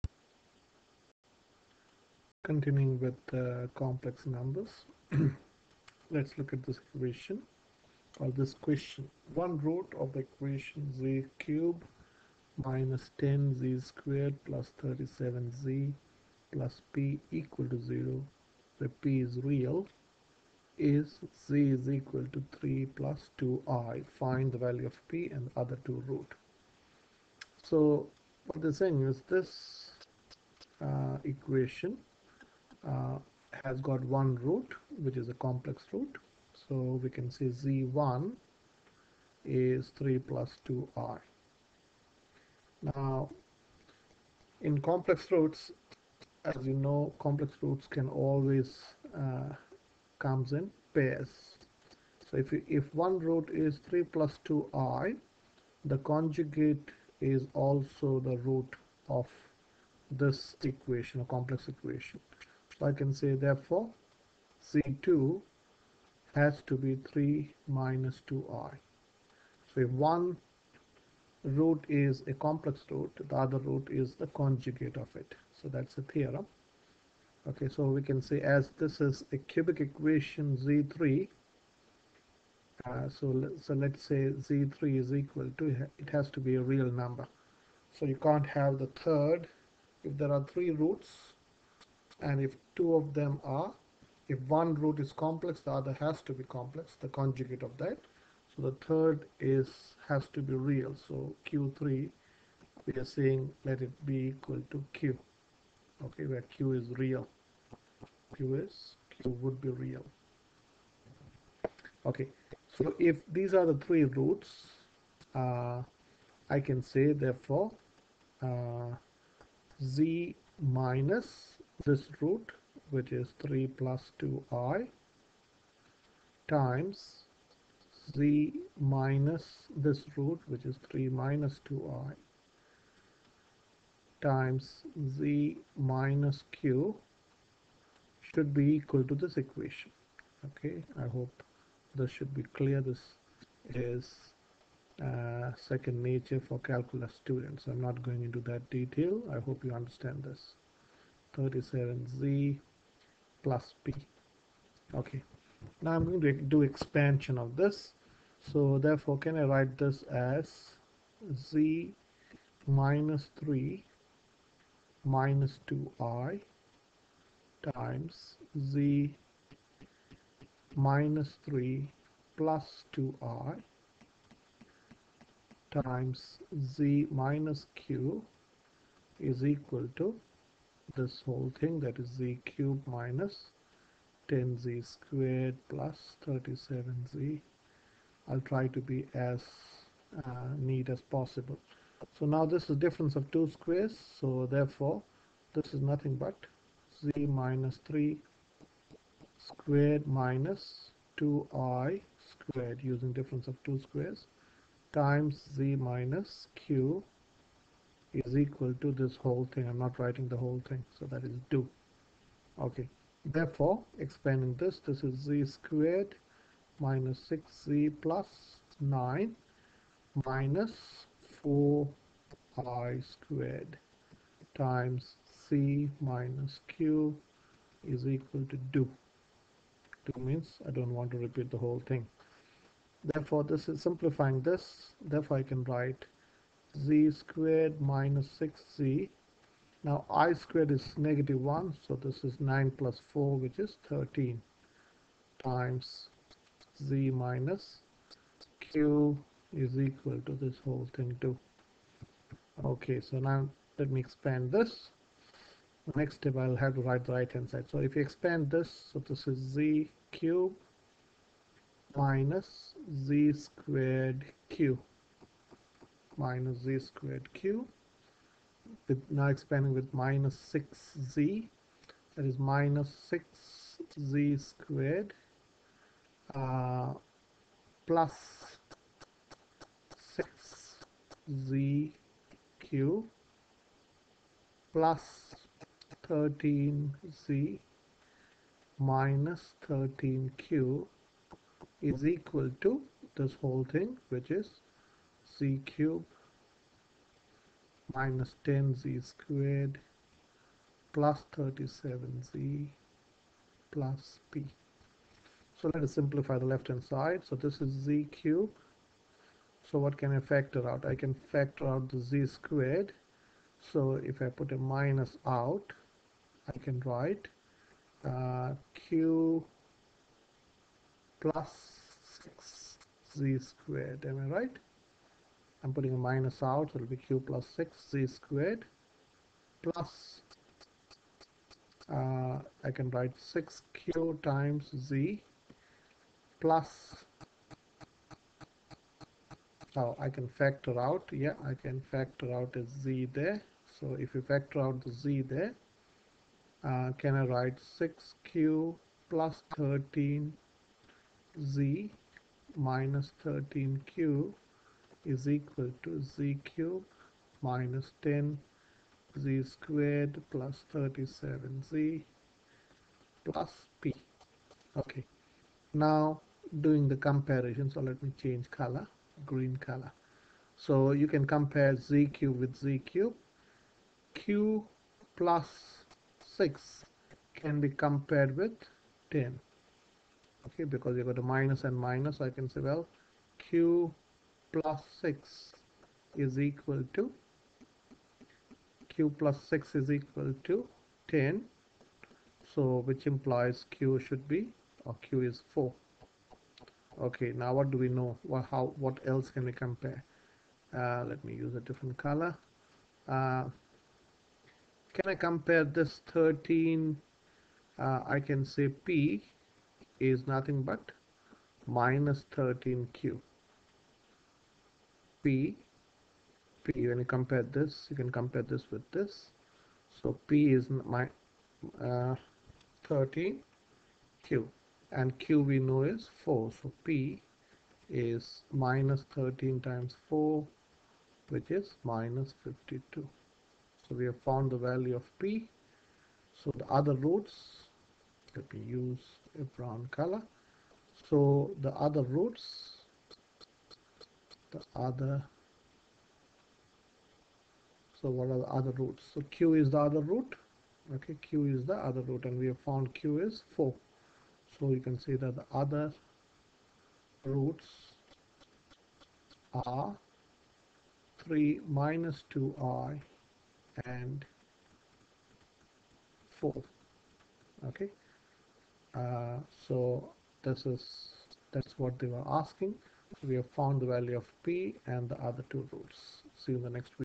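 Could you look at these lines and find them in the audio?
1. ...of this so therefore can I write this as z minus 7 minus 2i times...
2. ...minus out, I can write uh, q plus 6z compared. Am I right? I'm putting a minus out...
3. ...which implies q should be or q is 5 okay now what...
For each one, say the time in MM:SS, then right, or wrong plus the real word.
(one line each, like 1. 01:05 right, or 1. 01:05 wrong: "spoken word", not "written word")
1. 02:37 wrong: "3", not "7"
2. 05:14 wrong: "squared", not "compared"
3. 06:32 wrong: "4", not "5".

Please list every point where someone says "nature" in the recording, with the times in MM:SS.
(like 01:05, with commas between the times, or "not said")
02:26.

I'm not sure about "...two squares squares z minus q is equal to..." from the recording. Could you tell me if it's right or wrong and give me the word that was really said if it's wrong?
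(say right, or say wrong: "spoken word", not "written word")
wrong: "times", not "squares".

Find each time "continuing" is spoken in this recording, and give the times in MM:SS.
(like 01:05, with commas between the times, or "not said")
00:02.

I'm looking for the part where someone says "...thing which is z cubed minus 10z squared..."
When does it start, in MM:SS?
04:53.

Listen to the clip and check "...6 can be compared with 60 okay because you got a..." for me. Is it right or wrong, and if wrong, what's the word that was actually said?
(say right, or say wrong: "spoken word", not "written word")
wrong: "10", not "60".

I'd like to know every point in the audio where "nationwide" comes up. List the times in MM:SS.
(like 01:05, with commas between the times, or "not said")
not said.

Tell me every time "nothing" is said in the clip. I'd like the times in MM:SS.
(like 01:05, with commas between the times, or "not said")
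03:15, 06:50.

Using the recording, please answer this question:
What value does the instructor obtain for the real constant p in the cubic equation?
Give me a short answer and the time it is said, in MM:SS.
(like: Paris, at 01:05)
-52, at 07:11.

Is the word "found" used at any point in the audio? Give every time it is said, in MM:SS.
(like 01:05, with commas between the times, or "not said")
07:14, 07:32, 07:53.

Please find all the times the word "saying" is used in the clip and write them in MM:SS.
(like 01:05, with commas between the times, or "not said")
00:28, 01:43.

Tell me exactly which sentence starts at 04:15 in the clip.
The next step I'll have to write the right hand side.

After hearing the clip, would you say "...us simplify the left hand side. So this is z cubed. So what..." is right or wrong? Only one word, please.
right.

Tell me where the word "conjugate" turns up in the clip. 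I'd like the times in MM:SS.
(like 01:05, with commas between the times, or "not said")
00:55, 01:14, 01:37.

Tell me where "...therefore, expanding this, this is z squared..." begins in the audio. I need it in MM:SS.
03:33.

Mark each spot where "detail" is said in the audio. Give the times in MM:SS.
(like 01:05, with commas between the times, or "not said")
02:28.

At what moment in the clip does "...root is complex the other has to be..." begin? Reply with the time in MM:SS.
01:34.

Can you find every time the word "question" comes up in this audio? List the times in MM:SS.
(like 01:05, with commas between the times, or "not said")
00:08.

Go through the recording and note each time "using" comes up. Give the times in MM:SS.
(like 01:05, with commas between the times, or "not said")
03:22.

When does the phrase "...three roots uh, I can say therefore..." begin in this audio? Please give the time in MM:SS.
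01:53.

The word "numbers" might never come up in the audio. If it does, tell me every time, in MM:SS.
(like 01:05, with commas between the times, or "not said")
00:04, 01:26.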